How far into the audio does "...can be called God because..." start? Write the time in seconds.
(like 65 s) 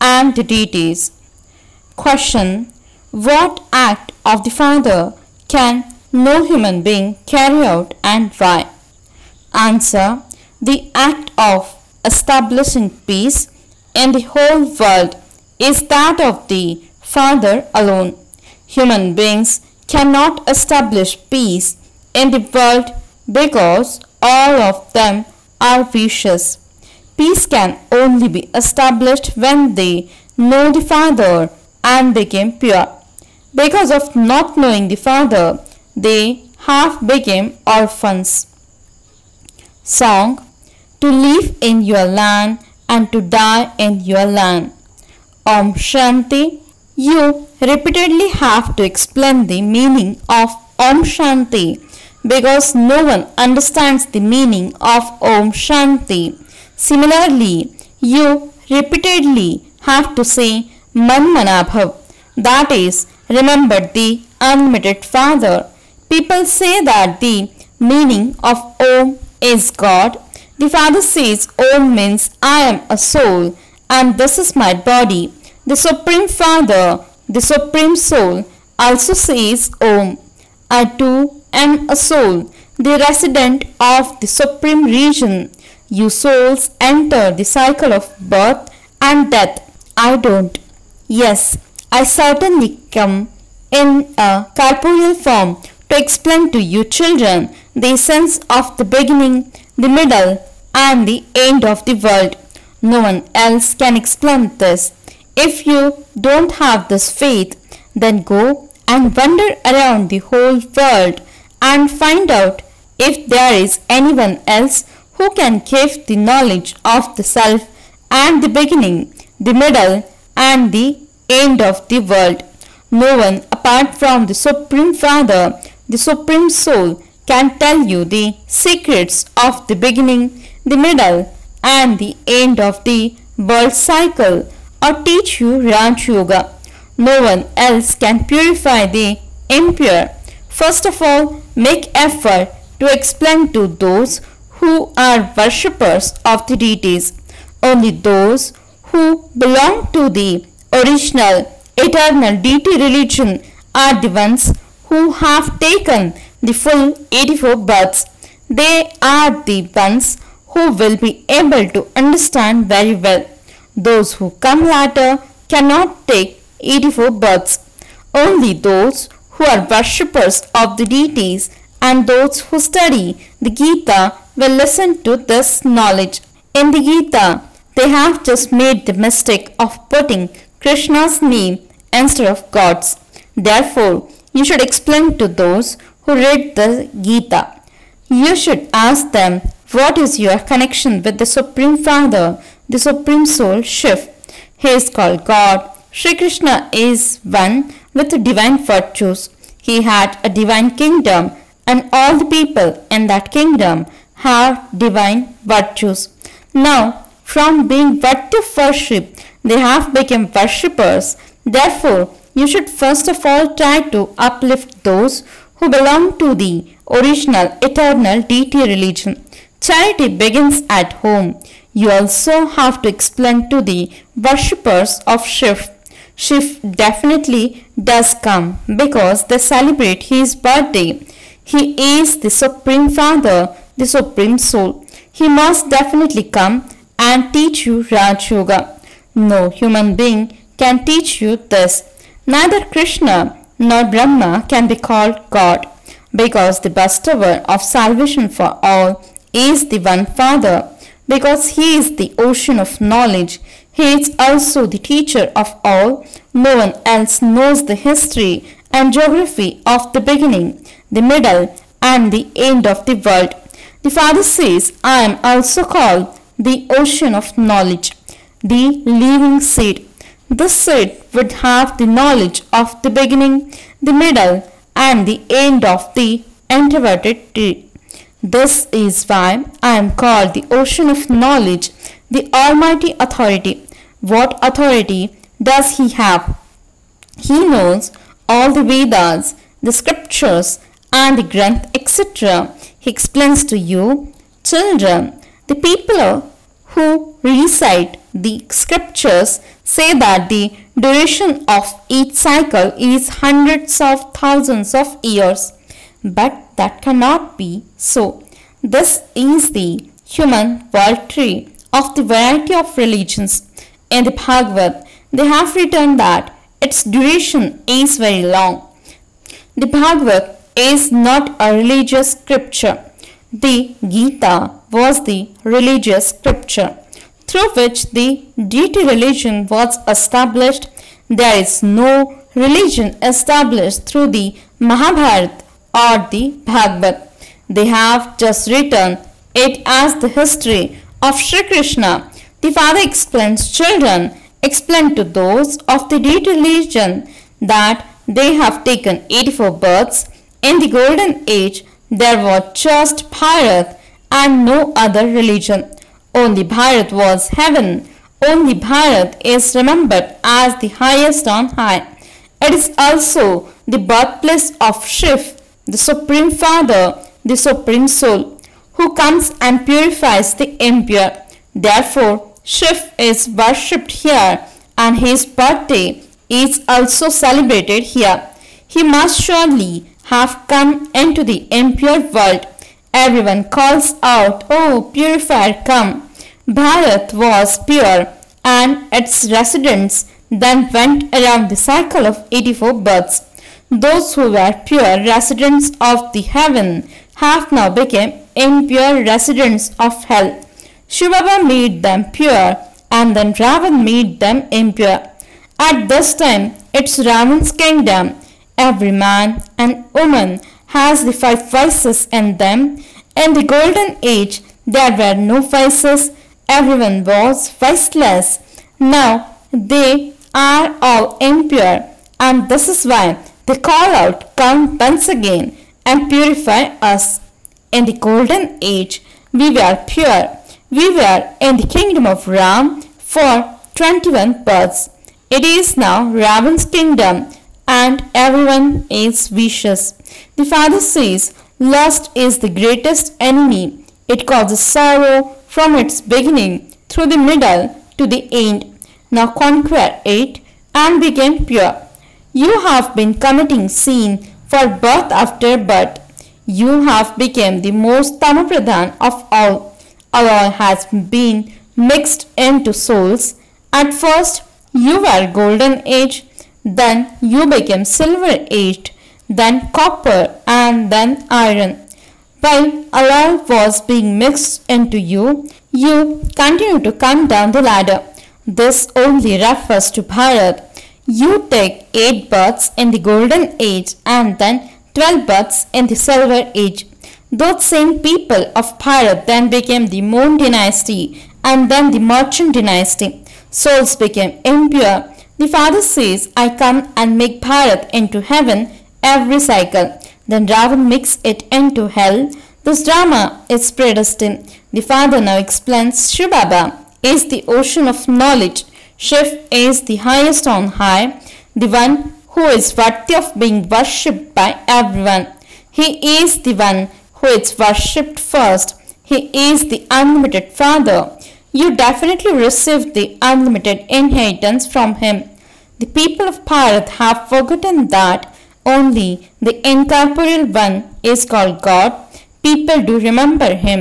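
244 s.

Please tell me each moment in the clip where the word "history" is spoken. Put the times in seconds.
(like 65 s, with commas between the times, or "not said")
257 s, 340 s.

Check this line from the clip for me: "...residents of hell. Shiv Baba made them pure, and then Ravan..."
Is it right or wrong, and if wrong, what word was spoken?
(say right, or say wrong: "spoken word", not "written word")
right.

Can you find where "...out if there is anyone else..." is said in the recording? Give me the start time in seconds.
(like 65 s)
112 s.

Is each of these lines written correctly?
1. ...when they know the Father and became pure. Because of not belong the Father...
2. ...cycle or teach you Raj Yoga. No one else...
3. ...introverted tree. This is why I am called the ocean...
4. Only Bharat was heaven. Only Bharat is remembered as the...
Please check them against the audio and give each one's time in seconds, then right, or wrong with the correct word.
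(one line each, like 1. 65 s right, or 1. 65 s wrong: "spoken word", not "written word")
1. 29 s wrong: "knowing", not "belong"
2. 133 s right
3. 276 s right
4. 356 s right.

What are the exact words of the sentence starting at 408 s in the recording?
Every man and woman has the five vices in them.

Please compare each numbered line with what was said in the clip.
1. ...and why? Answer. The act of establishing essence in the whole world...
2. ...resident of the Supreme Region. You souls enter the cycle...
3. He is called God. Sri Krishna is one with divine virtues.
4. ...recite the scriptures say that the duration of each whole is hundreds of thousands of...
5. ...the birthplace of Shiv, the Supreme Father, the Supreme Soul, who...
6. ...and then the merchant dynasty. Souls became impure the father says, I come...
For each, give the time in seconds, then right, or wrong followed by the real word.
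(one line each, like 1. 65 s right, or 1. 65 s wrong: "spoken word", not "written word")
1. 8 s wrong: "peace", not "essence"
2. 83 s right
3. 194 s right
4. 297 s wrong: "cycle", not "whole"
5. 363 s right
6. 491 s right.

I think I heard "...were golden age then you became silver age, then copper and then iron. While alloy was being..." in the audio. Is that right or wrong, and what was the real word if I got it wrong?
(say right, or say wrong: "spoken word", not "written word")
right.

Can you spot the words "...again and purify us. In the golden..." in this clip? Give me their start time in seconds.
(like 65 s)
425 s.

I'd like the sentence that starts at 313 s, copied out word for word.
In the Bhagavad, they have written that its duration is very long.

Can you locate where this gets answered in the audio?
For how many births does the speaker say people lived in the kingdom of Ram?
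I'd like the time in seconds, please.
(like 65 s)
433 s.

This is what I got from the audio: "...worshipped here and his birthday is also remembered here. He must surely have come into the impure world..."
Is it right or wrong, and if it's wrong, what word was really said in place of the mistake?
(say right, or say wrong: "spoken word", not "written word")
wrong: "celebrated", not "remembered".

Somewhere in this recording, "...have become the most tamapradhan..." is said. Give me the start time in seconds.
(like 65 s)
456 s.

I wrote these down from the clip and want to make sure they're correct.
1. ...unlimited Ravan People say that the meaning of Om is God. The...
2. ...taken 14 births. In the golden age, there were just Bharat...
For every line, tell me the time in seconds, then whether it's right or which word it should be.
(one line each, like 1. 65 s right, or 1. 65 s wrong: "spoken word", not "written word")
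1. 64 s wrong: "Father", not "Ravan"
2. 348 s wrong: "84", not "14".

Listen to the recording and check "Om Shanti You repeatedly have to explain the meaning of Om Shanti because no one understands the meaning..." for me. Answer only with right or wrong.
right.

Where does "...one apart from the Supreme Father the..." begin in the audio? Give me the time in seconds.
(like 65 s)
123 s.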